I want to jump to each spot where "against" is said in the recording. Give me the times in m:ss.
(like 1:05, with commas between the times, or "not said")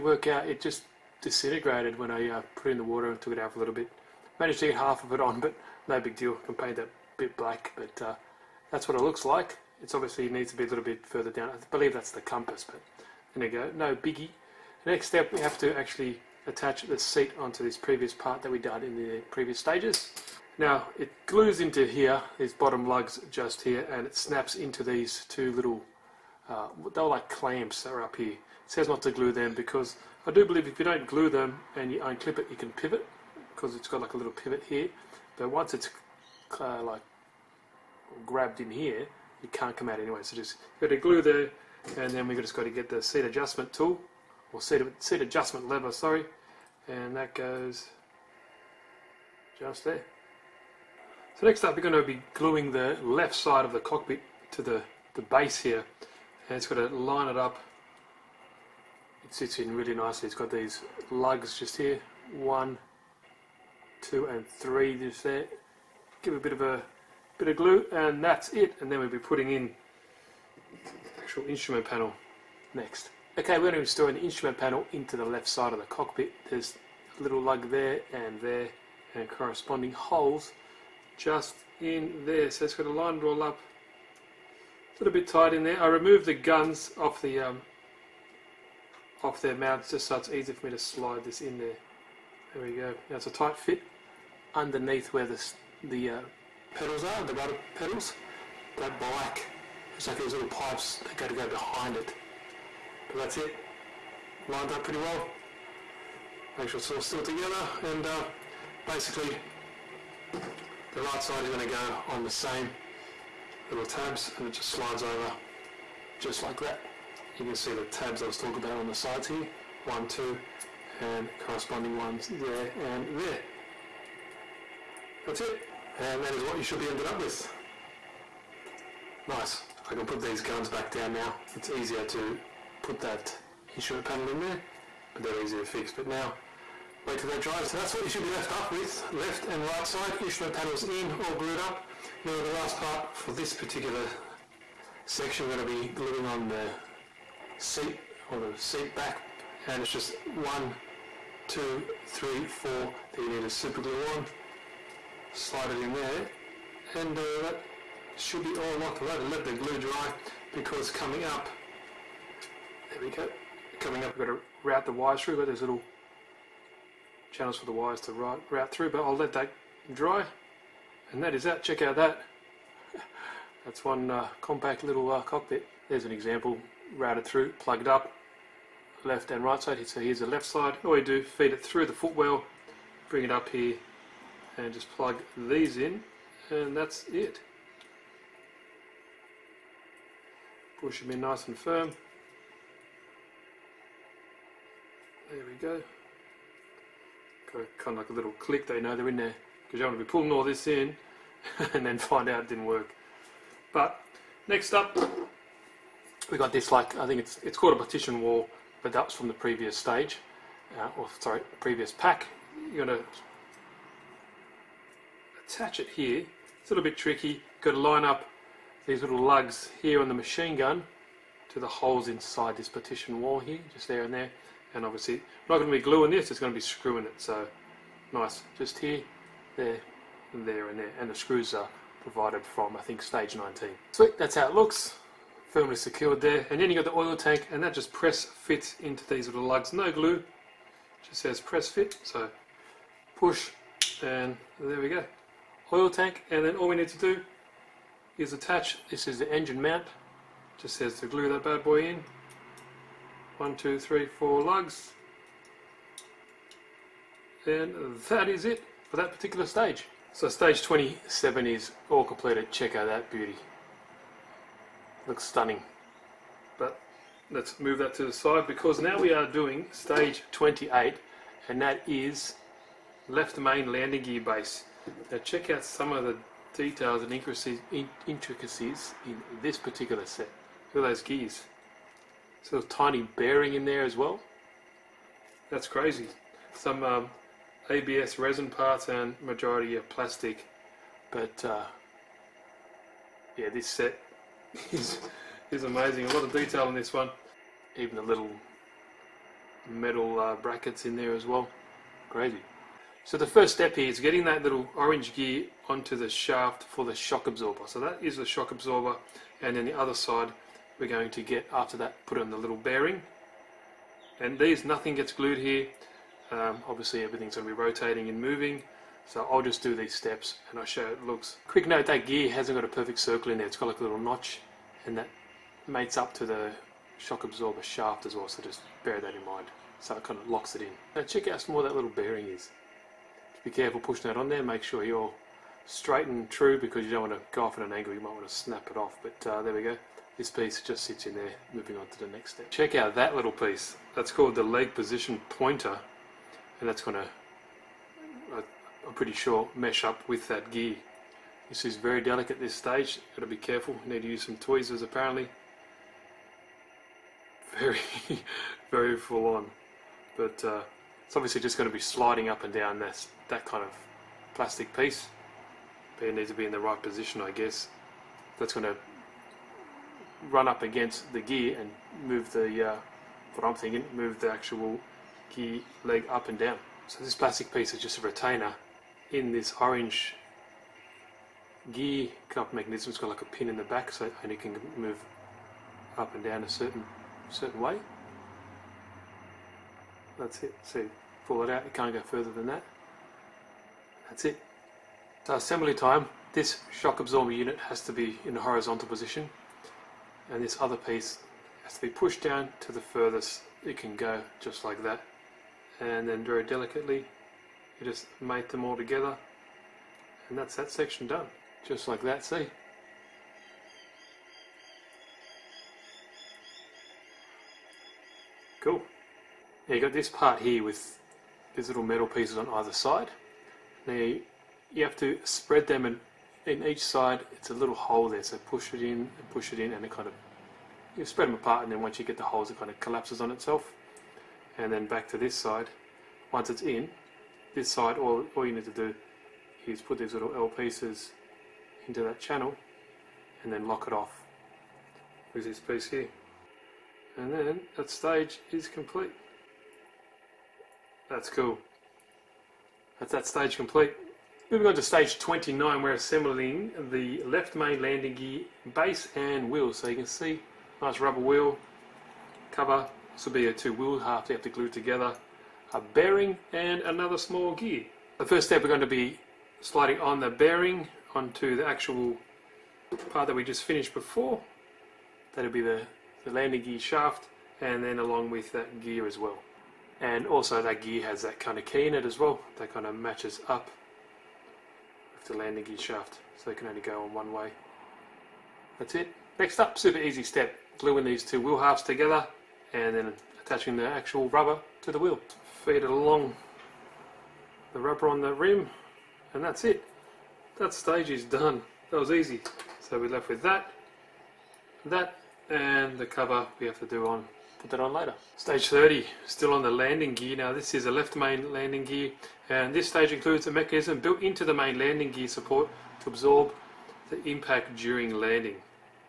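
6:10.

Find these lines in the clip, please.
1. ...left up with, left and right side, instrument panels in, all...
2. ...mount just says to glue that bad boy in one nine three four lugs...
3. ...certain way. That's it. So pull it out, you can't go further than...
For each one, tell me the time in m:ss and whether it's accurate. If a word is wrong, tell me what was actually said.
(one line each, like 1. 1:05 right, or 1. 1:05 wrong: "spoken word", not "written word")
1. 2:18 right
2. 4:09 wrong: "two", not "nine"
3. 6:27 right.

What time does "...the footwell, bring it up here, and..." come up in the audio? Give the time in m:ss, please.
3:01.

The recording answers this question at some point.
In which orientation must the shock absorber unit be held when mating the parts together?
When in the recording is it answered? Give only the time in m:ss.
6:38.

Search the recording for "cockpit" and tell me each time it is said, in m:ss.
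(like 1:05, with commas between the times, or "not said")
0:53, 1:15, 2:55.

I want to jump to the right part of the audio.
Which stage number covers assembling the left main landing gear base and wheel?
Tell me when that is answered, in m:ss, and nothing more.
7:34.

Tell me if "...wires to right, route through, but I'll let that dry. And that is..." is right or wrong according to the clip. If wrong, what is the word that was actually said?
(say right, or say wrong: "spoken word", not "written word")
right.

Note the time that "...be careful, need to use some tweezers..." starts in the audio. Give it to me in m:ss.
5:53.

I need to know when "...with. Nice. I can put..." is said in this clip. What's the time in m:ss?
2:07.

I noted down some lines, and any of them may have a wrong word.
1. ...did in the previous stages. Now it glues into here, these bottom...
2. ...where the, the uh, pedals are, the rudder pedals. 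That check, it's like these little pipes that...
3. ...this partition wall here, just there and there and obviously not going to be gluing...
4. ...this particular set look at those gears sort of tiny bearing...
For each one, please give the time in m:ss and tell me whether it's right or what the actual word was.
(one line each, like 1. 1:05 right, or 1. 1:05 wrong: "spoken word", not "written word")
1. 0:18 right
2. 1:35 wrong: "black", not "check"
3. 3:42 right
4. 4:39 right.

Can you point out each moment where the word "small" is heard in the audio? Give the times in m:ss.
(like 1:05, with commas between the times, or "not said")
5:31, 7:47.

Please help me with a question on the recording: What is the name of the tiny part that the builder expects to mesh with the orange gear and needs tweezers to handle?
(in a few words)
Leg position pointer.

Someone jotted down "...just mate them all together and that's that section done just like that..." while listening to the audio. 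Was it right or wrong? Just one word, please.
right.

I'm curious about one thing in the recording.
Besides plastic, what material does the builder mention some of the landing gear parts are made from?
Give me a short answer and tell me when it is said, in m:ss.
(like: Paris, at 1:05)
ABS resin, at 4:47.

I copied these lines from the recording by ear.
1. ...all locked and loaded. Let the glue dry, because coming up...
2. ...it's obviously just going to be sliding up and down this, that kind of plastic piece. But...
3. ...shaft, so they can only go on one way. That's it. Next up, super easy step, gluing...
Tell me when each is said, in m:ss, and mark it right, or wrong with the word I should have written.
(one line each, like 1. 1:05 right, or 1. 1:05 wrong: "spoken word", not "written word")
1. 2:38 right
2. 6:01 right
3. 8:05 right.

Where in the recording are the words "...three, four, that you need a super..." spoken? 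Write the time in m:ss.
2:32.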